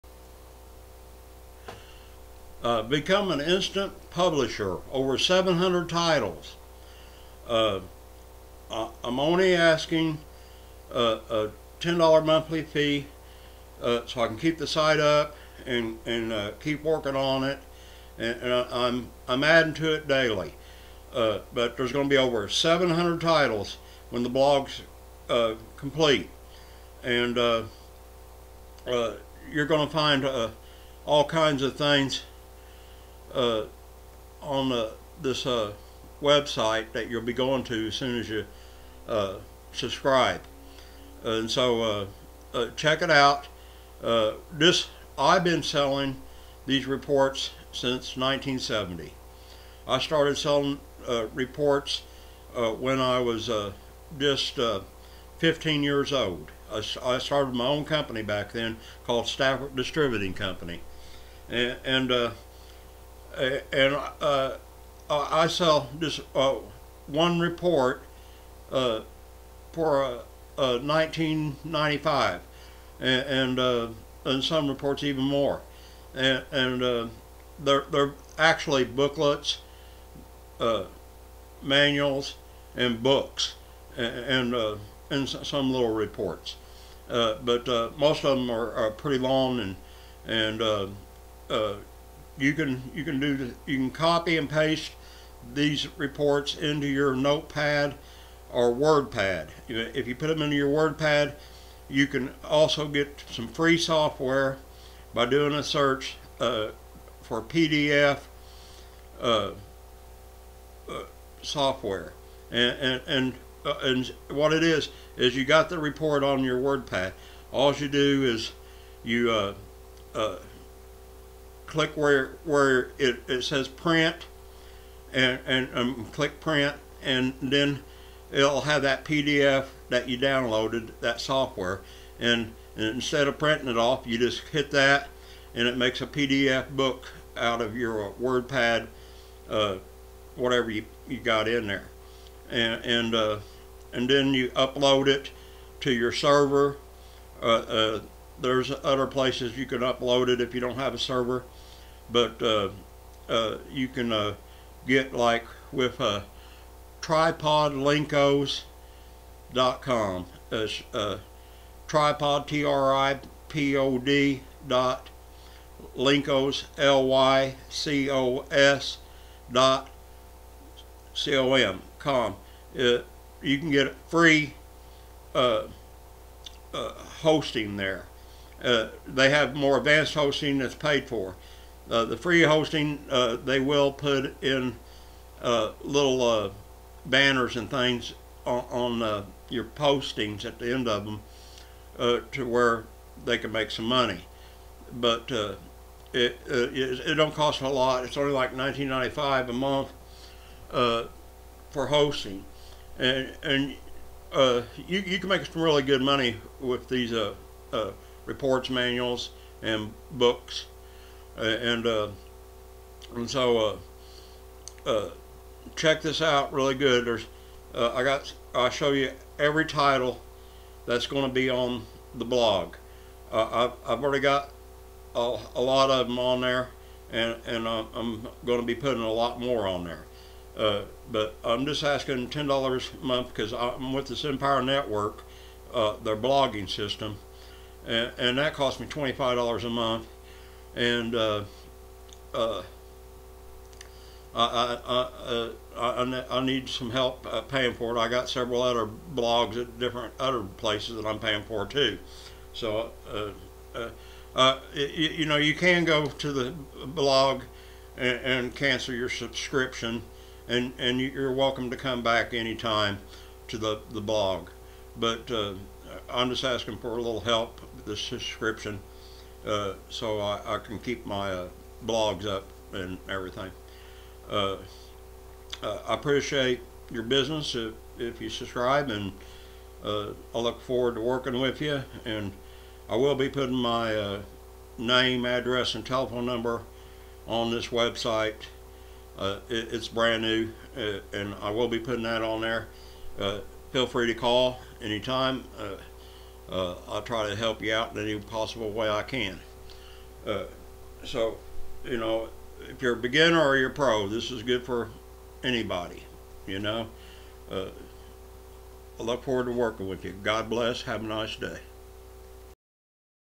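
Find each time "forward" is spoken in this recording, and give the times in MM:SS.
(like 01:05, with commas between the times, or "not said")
04:40, 05:09.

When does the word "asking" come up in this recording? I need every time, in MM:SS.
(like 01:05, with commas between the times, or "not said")
00:09, 03:51, 04:26.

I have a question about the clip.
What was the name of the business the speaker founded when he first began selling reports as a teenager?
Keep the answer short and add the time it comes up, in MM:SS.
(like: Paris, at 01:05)
Stafford Distributing Company, at 00:59.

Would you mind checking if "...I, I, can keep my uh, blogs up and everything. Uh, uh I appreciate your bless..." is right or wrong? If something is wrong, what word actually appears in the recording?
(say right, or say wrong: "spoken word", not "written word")
wrong: "business", not "bless".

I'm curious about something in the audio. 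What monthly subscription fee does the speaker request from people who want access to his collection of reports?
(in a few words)
$10.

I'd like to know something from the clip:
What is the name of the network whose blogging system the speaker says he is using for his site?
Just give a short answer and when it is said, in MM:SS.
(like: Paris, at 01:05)
Empire Network, at 03:54.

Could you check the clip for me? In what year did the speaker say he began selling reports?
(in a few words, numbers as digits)
1970.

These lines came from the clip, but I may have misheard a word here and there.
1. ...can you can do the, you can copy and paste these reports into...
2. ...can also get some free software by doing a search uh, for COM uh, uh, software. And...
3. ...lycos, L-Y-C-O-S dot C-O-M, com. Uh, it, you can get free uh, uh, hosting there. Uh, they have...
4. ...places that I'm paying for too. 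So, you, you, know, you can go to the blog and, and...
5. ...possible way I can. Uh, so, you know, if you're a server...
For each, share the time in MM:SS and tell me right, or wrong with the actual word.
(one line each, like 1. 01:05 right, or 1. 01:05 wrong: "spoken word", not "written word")
1. 01:32 right
2. 01:42 wrong: "PDF", not "COM"
3. 02:45 right
4. 04:10 right
5. 04:58 wrong: "beginner", not "server".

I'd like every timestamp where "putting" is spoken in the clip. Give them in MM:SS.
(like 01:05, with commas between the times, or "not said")
03:48, 04:43, 04:51.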